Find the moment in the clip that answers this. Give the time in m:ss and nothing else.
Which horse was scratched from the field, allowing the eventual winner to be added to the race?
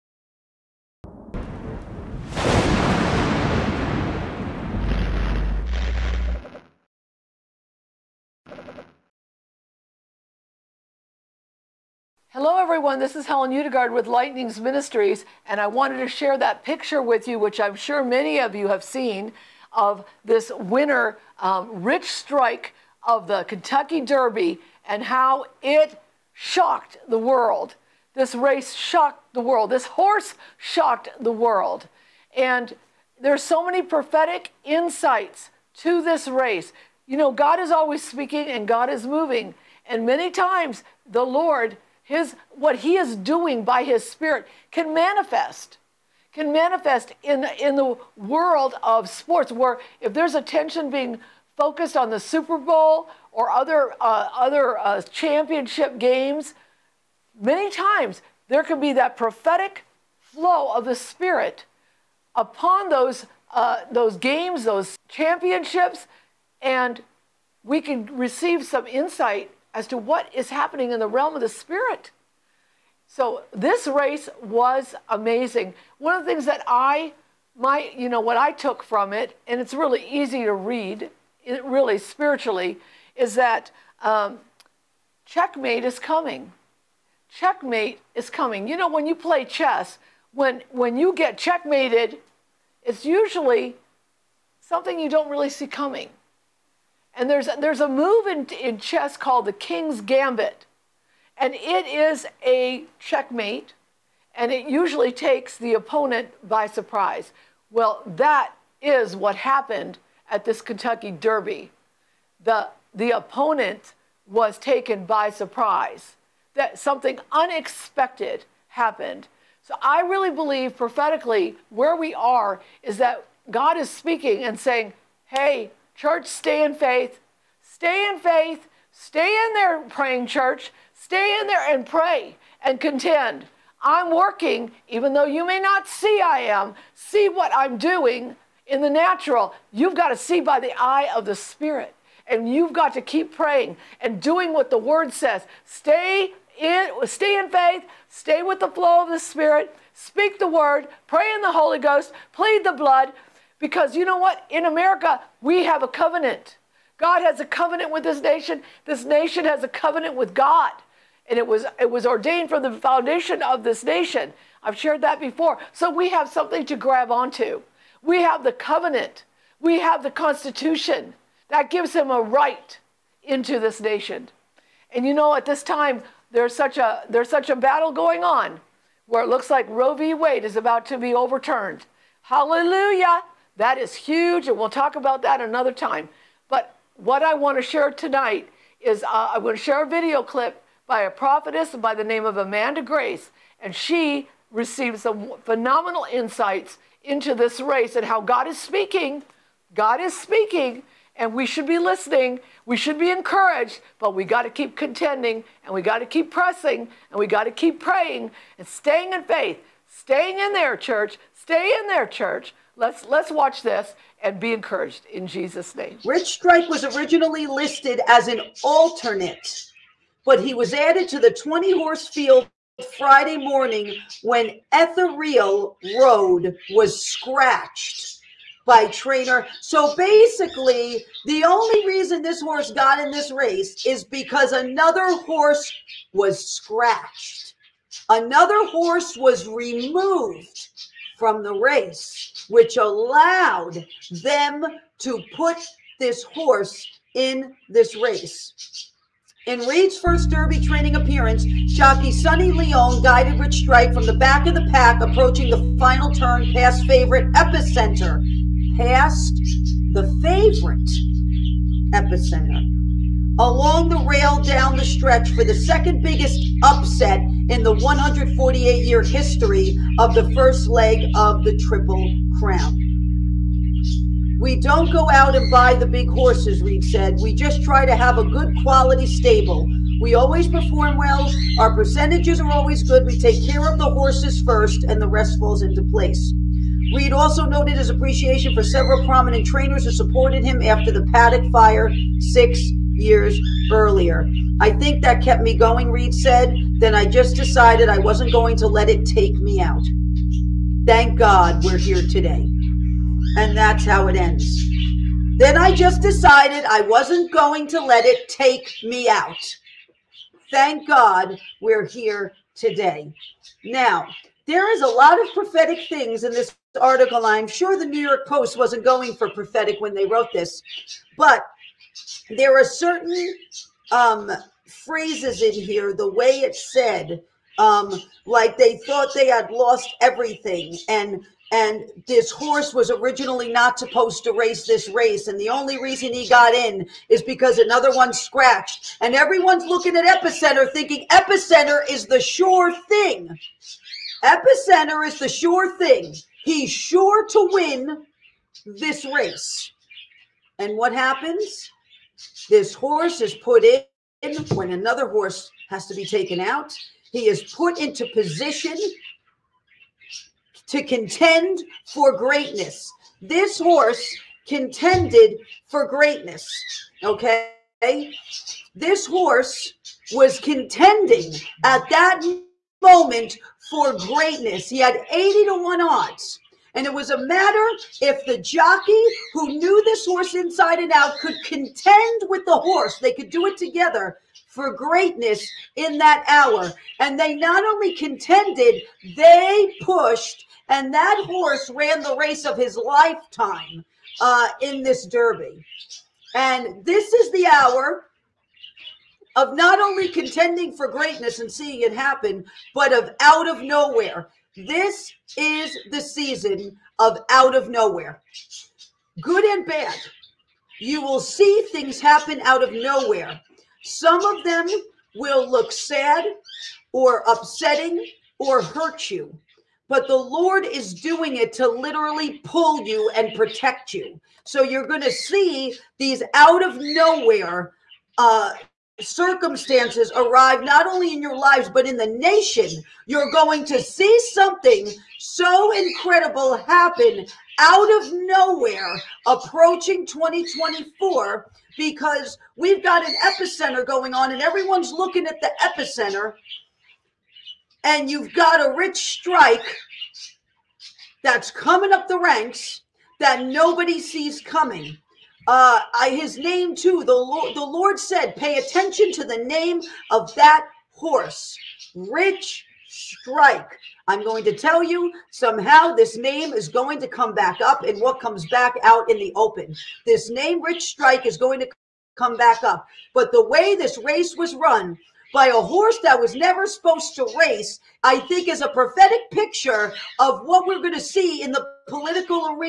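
3:44.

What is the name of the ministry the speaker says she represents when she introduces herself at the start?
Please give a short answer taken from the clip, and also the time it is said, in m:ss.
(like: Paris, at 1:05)
Lightnings Ministries, at 0:14.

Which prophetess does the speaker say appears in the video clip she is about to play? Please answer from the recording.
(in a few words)
Amanda Grace.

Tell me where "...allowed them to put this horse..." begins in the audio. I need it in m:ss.
4:02.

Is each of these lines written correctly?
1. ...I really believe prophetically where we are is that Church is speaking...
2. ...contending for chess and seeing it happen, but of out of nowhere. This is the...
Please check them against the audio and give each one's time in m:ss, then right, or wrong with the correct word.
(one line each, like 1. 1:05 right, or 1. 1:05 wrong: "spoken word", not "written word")
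1. 1:59 wrong: "God", not "Church"
2. 6:40 wrong: "greatness", not "chess".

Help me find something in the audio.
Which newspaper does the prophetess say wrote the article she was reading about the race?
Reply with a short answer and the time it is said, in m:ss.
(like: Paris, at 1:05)
New York Post, at 5:17.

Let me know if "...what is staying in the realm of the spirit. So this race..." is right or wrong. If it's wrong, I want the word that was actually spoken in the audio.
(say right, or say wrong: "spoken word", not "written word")
wrong: "happening", not "staying".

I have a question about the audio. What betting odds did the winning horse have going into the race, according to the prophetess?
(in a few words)
80 to 1.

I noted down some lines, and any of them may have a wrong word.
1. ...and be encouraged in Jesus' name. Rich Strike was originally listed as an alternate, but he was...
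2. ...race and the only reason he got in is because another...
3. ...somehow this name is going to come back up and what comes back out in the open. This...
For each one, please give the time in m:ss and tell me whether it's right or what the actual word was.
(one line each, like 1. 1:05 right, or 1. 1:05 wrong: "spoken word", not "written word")
1. 3:34 right
2. 5:34 right
3. 7:45 right.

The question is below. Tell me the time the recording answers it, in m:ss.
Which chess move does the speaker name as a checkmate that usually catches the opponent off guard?
1:39.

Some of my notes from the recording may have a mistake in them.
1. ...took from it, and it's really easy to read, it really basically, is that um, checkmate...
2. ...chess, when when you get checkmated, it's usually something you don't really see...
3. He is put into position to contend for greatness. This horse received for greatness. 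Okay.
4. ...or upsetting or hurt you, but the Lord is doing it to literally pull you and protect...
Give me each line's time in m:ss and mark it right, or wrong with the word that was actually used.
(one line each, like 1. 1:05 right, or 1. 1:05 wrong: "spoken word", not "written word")
1. 1:18 wrong: "spiritually", not "basically"
2. 1:29 right
3. 5:57 wrong: "contended", not "received"
4. 6:56 right.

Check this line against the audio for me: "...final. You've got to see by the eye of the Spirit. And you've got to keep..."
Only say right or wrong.
wrong.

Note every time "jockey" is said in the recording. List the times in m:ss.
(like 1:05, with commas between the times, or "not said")
4:11, 6:18.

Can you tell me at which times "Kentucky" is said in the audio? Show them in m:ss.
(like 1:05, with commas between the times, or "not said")
0:23, 1:50.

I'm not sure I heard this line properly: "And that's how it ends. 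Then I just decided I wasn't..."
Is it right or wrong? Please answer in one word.
right.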